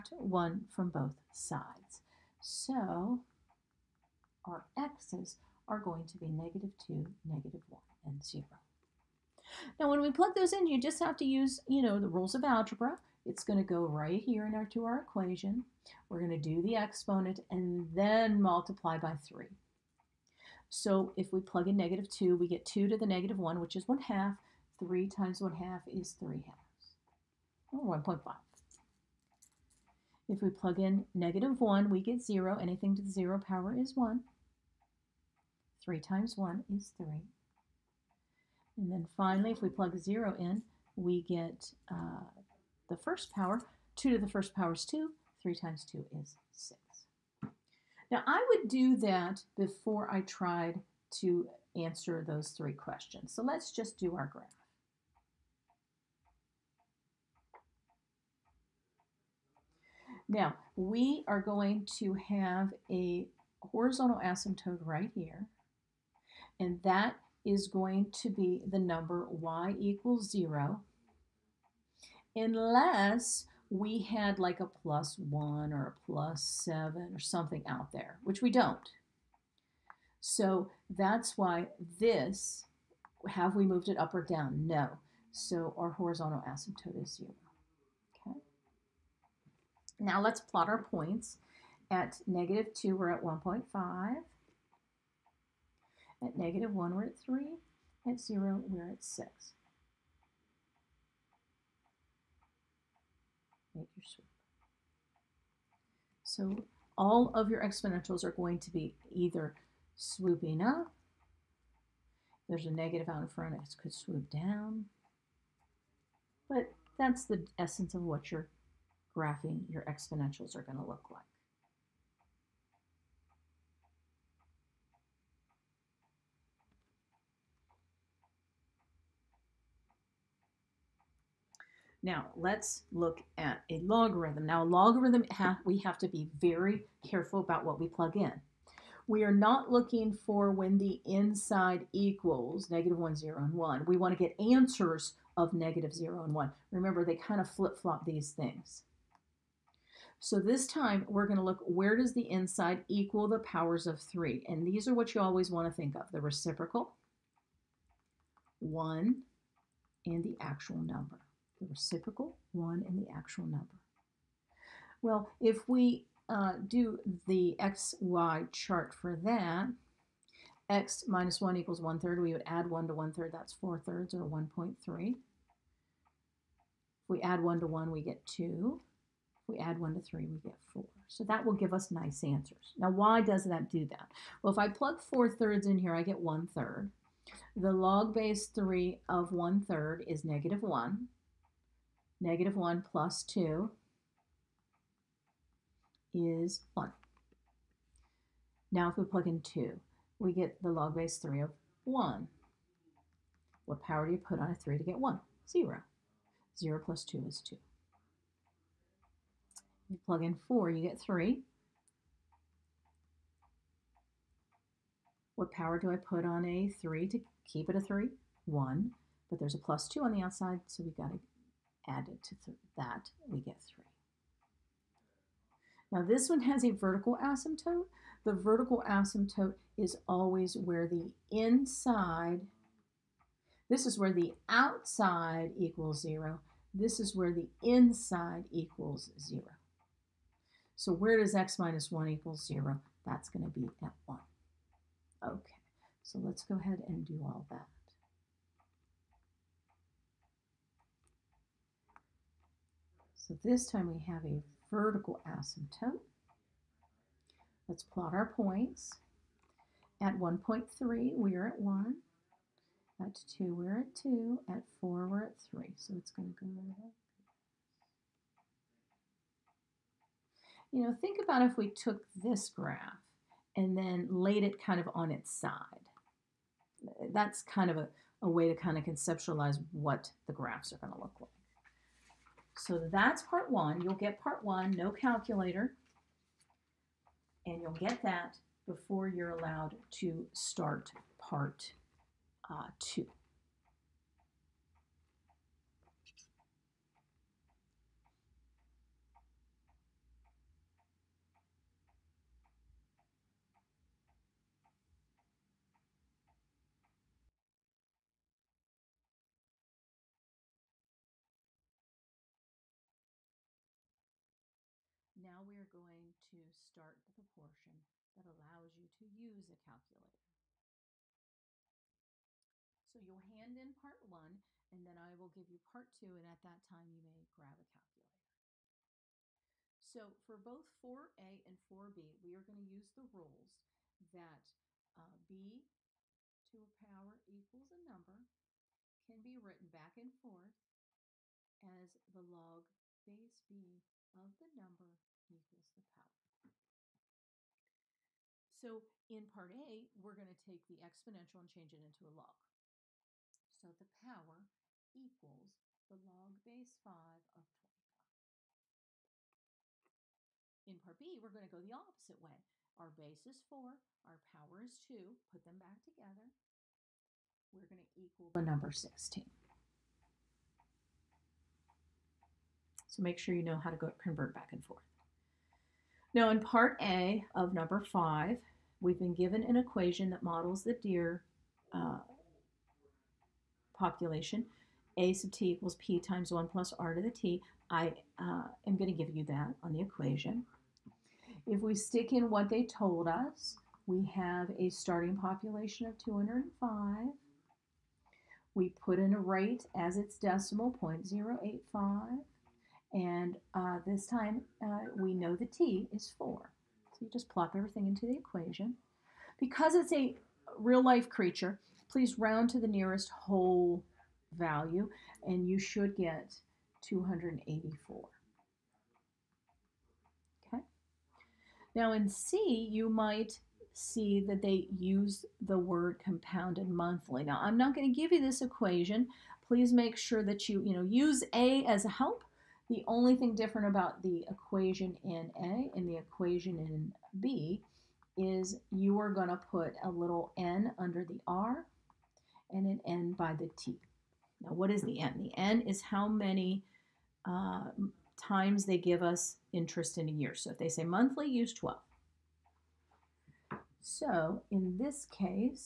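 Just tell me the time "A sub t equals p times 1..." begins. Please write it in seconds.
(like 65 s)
384 s.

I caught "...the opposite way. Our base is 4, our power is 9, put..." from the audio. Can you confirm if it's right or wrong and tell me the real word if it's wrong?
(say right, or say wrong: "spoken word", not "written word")
wrong: "2", not "9".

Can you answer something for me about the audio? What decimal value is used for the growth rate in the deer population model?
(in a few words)
0.085.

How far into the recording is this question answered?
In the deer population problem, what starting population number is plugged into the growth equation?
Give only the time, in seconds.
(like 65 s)
396 s.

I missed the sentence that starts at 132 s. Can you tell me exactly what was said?
Now, let's look at a logarithm.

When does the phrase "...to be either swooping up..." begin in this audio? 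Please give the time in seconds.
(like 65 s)
108 s.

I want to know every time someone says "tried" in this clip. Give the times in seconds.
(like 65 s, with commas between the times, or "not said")
50 s.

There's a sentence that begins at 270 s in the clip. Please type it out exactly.
you know, think about if we took this graph and then laid it kind of on its side.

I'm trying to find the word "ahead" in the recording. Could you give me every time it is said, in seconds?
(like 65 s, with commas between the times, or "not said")
246 s.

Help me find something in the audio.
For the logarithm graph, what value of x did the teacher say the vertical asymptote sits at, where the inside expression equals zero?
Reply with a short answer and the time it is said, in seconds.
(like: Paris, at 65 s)
1, at 243 s.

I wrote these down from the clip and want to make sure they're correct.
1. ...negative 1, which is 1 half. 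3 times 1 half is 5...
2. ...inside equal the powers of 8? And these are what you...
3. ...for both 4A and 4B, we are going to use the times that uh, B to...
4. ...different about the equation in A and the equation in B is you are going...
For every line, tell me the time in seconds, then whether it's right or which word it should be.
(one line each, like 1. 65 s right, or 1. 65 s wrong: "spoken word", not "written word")
1. 23 s wrong: "3", not "5"
2. 152 s wrong: "3", not "8"
3. 330 s wrong: "rules", not "times"
4. 433 s right.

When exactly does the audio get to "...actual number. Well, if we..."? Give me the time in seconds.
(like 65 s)
163 s.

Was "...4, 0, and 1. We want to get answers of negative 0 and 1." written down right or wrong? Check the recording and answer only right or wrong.
wrong.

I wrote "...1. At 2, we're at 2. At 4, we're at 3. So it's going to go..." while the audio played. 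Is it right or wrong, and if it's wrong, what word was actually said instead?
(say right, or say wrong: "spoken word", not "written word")
right.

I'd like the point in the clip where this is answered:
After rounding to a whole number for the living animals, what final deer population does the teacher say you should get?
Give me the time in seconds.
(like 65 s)
416 s.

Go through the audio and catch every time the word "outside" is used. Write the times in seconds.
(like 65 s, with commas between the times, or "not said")
220 s, 234 s.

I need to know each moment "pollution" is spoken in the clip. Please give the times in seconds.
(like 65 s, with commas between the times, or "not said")
not said.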